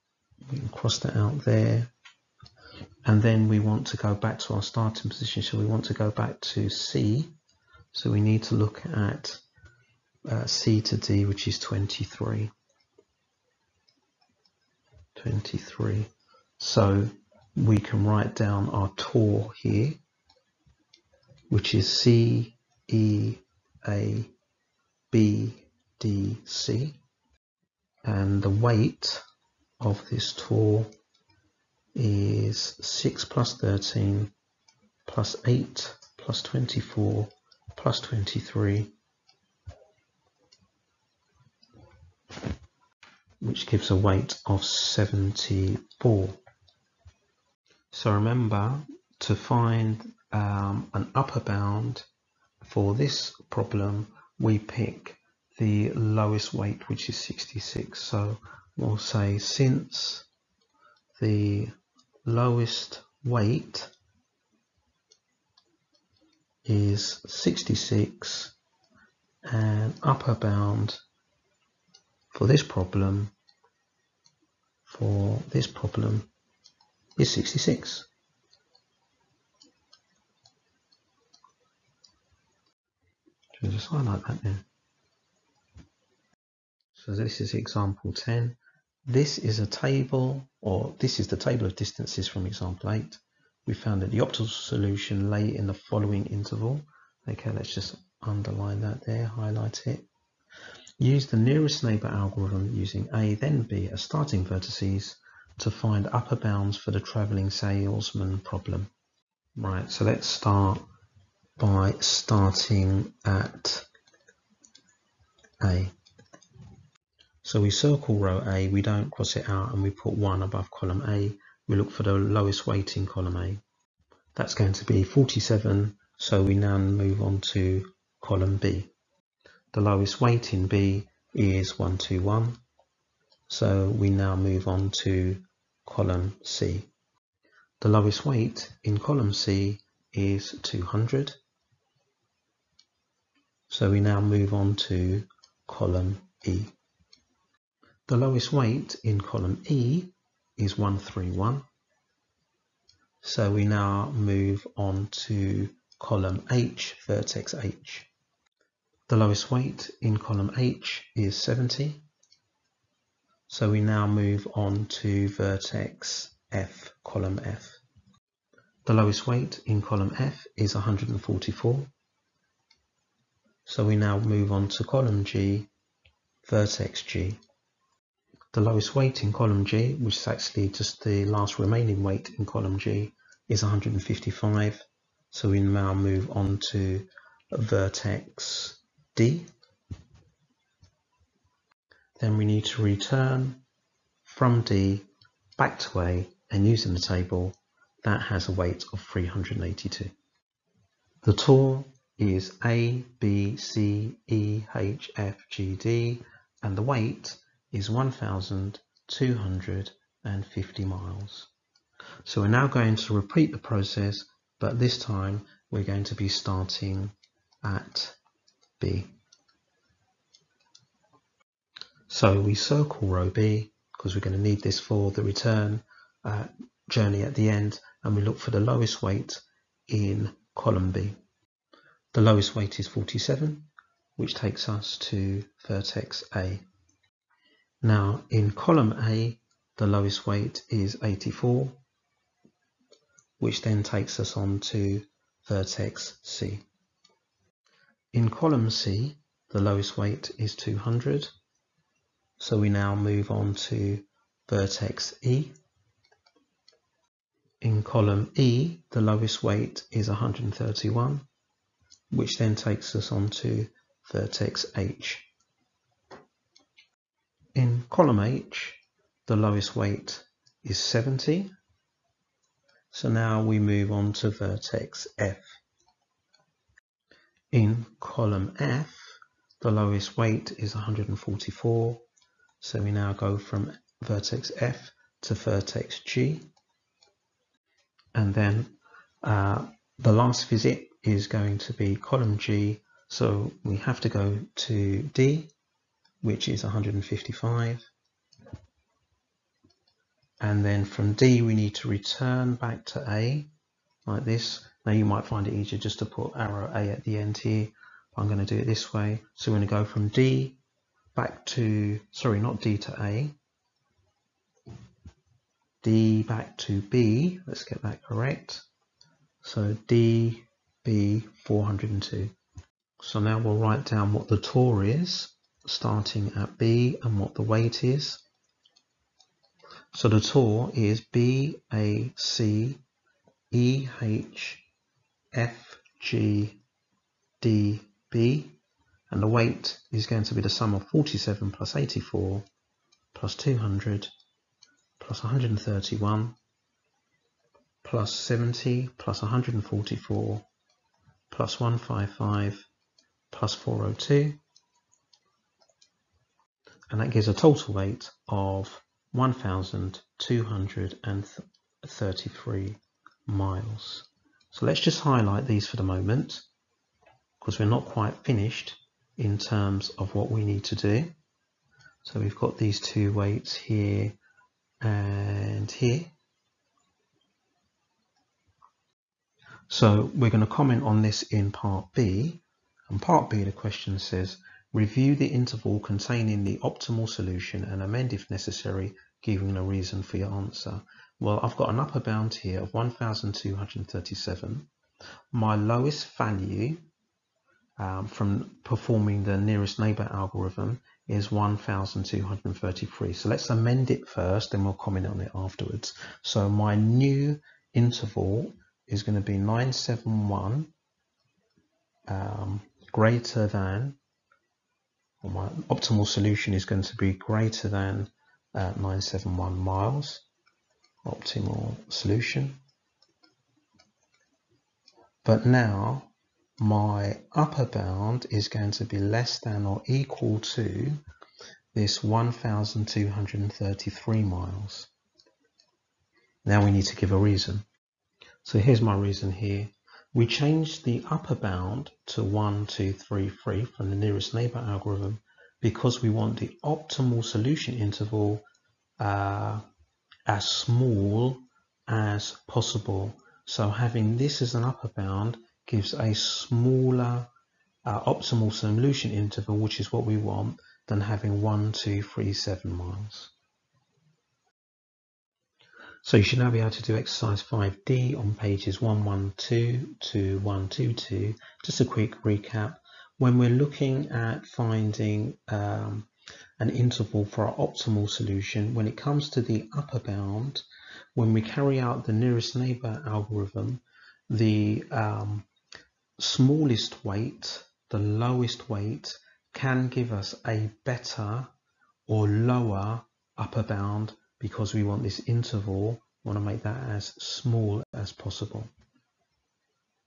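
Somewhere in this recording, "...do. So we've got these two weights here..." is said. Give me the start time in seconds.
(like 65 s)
370 s.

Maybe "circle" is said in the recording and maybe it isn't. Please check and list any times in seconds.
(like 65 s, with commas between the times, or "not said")
117 s, 222 s.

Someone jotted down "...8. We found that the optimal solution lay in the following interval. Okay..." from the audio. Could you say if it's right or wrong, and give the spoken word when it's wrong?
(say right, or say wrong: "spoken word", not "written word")
right.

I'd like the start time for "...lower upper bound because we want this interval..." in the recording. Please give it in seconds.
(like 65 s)
492 s.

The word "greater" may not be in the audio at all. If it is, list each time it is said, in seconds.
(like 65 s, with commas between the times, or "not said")
412 s, 417 s.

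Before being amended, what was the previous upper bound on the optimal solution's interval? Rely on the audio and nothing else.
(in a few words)
1,237.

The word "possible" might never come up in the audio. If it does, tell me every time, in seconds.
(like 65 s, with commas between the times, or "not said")
452 s, 498 s.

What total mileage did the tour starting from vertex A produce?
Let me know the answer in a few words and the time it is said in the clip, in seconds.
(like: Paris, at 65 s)
1,250 miles, at 207 s.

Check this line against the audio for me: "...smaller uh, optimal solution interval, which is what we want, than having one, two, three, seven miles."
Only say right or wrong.
right.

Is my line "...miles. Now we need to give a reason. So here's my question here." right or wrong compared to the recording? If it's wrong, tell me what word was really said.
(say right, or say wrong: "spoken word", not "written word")
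wrong: "reason", not "question".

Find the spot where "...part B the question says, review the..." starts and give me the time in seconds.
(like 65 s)
383 s.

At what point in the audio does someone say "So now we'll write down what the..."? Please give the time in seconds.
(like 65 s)
323 s.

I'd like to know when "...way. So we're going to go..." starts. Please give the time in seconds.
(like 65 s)
308 s.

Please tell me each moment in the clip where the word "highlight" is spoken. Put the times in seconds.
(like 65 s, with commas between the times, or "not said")
83 s, 99 s, 365 s.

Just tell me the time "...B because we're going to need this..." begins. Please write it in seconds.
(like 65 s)
223 s.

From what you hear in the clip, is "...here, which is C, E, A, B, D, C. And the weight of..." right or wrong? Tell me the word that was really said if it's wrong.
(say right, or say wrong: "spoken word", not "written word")
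right.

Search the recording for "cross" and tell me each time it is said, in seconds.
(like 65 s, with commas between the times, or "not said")
0 s, 119 s.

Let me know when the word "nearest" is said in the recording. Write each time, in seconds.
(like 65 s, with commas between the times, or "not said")
101 s, 399 s, 443 s, 482 s.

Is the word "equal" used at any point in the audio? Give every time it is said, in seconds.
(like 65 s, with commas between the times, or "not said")
429 s.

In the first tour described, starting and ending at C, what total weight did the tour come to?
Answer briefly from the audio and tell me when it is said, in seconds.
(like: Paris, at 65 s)
74, at 44 s.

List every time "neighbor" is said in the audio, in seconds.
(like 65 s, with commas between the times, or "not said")
101 s, 399 s, 444 s, 482 s.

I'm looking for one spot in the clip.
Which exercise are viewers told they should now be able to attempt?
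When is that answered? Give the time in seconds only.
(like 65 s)
466 s.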